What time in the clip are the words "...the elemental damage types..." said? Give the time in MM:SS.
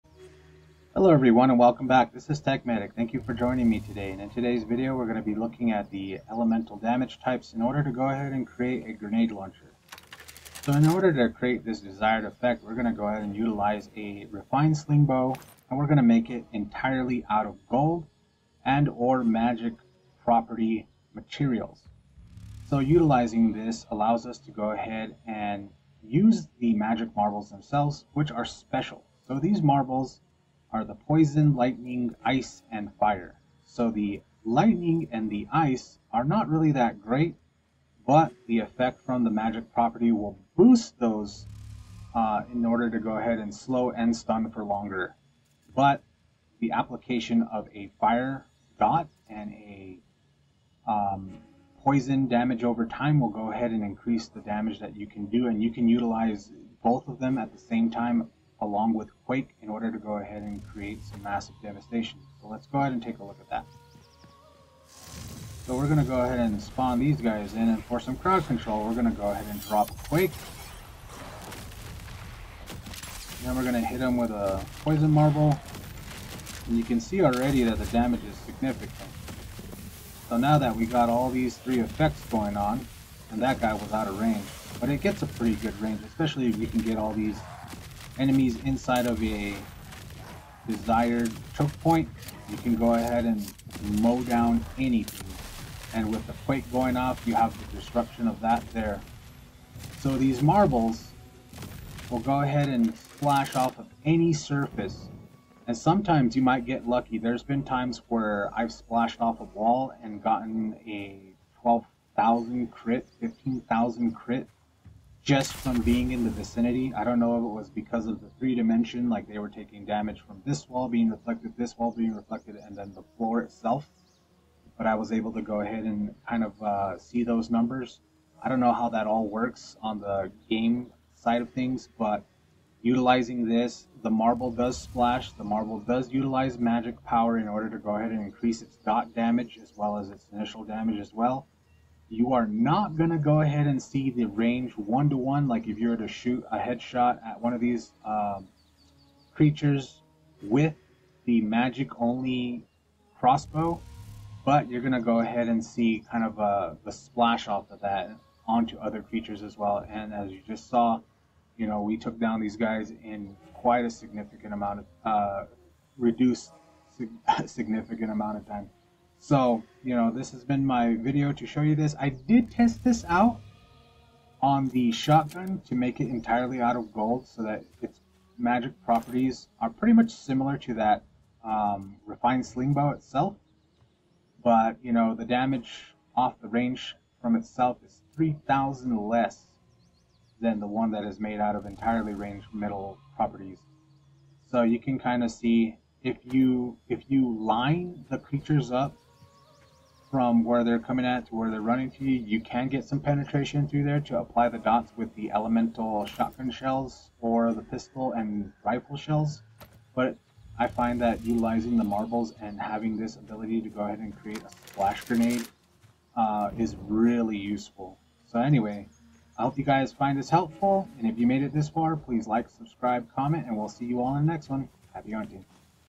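00:05.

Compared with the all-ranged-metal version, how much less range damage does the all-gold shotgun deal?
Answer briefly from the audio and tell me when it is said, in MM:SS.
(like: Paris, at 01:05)
3,000, at 03:08.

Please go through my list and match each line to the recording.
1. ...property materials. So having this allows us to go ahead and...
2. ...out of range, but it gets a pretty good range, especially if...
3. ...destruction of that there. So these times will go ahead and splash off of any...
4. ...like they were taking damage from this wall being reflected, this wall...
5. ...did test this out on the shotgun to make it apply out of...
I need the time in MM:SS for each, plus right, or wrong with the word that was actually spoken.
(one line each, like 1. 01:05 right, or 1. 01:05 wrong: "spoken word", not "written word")
1. 00:20 wrong: "utilizing", not "having"
2. 01:23 right
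3. 01:37 wrong: "marbles", not "times"
4. 01:59 right
5. 02:52 wrong: "entirely", not "apply".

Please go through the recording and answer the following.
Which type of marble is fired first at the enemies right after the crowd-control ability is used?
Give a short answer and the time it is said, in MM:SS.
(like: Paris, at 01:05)
Poison Marble, at 01:14.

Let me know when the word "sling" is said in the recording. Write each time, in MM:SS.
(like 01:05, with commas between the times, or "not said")
00:14, 03:02.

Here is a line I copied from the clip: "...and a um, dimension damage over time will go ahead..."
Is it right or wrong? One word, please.
wrong.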